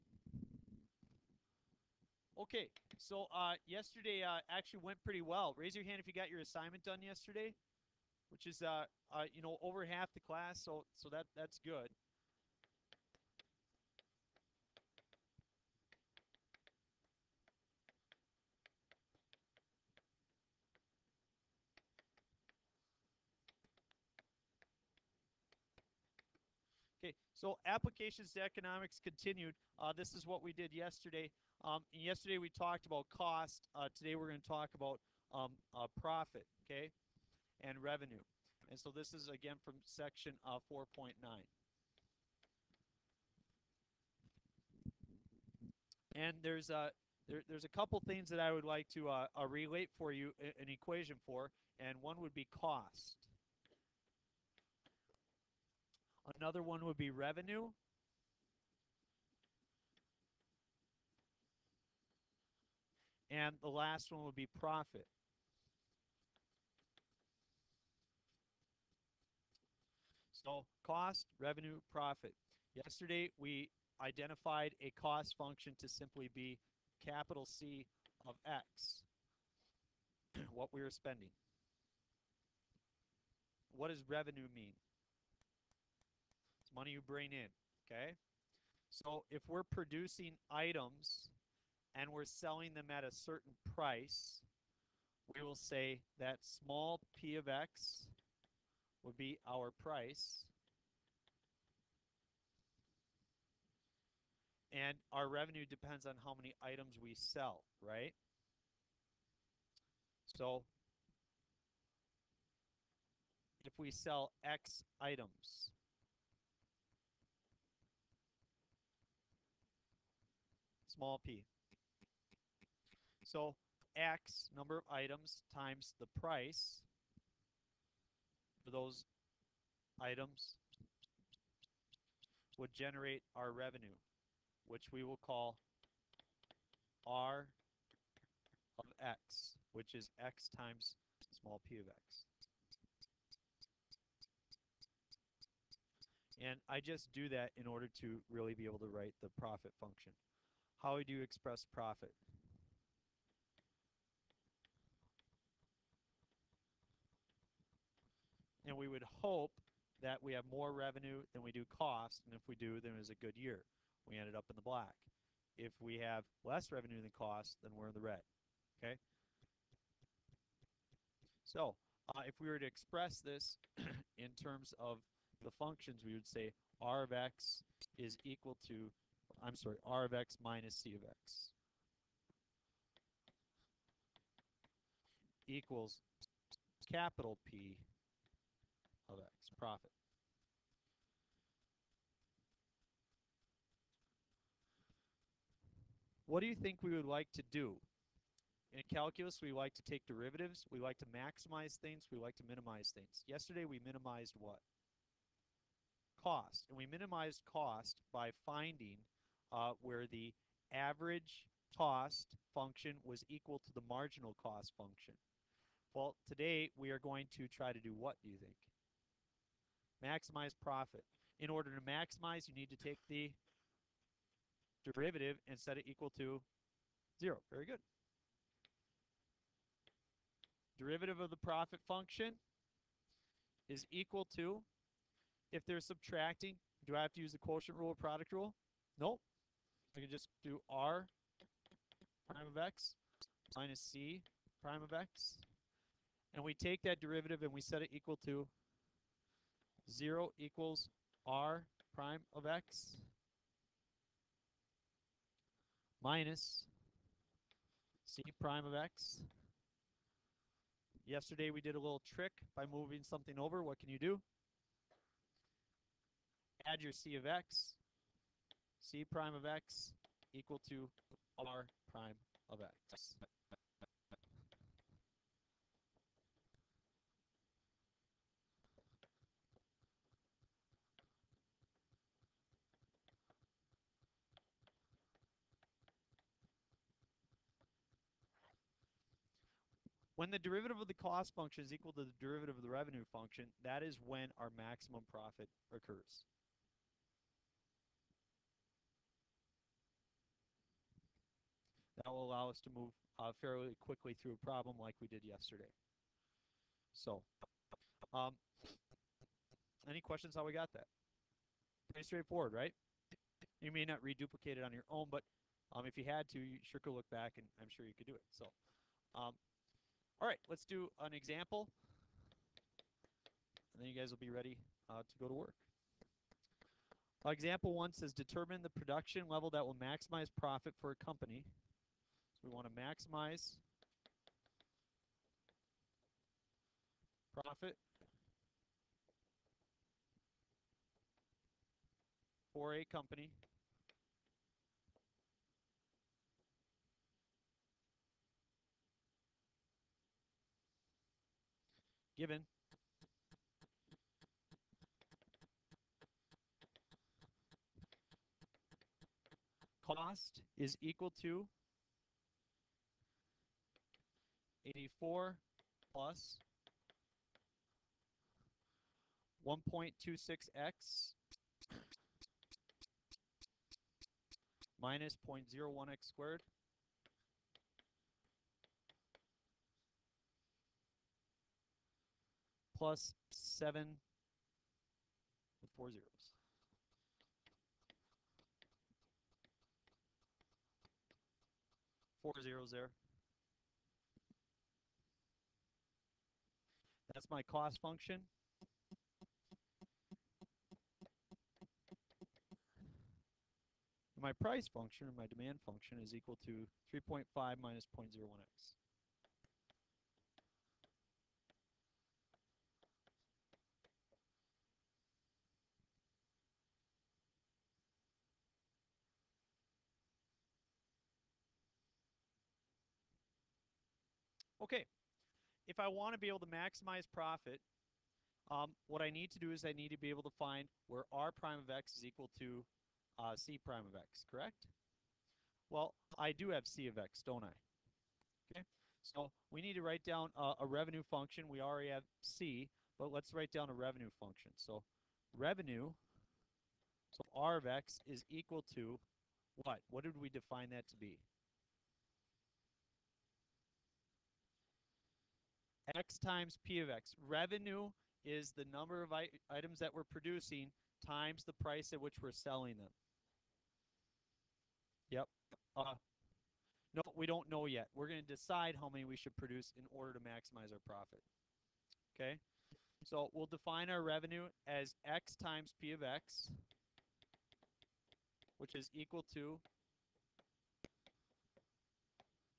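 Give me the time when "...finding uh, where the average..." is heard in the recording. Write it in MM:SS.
03:28.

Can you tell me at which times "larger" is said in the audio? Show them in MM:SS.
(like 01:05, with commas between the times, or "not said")
not said.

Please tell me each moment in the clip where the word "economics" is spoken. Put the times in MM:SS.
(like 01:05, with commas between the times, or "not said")
00:28.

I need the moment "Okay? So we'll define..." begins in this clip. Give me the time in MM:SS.
07:52.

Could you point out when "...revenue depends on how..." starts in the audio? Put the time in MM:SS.
01:45.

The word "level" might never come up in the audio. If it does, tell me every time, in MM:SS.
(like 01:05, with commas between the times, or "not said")
05:29.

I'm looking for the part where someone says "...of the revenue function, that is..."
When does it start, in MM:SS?
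04:52.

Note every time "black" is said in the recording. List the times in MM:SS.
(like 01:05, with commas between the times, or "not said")
02:44.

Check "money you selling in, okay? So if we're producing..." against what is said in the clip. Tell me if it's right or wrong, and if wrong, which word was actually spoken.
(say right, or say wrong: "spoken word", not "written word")
wrong: "bring", not "selling".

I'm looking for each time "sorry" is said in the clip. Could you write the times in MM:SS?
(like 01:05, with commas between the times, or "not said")
02:59.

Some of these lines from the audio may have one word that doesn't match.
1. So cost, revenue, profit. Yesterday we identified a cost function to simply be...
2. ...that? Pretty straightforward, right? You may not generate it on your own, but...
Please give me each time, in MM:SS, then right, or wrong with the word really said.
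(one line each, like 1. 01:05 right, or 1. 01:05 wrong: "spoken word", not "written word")
1. 01:10 right
2. 05:10 wrong: "reduplicate", not "generate".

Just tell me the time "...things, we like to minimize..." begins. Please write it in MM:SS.
03:21.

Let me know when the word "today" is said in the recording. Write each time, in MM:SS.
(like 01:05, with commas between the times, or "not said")
00:33, 03:36.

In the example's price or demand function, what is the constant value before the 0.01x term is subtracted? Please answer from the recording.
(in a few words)
3.5.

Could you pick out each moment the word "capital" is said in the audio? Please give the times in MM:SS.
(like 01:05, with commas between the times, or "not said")
01:17, 03:06.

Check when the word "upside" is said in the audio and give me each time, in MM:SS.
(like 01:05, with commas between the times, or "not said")
not said.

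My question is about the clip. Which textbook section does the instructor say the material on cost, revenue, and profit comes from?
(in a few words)
4.9.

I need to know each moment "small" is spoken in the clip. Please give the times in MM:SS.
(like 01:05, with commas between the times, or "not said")
01:36, 02:00, 02:21.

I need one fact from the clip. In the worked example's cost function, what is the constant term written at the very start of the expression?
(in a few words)
84.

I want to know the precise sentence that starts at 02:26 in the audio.
And I just do that in order to really be able to write the profit function.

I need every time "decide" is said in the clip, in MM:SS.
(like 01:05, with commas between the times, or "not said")
07:48.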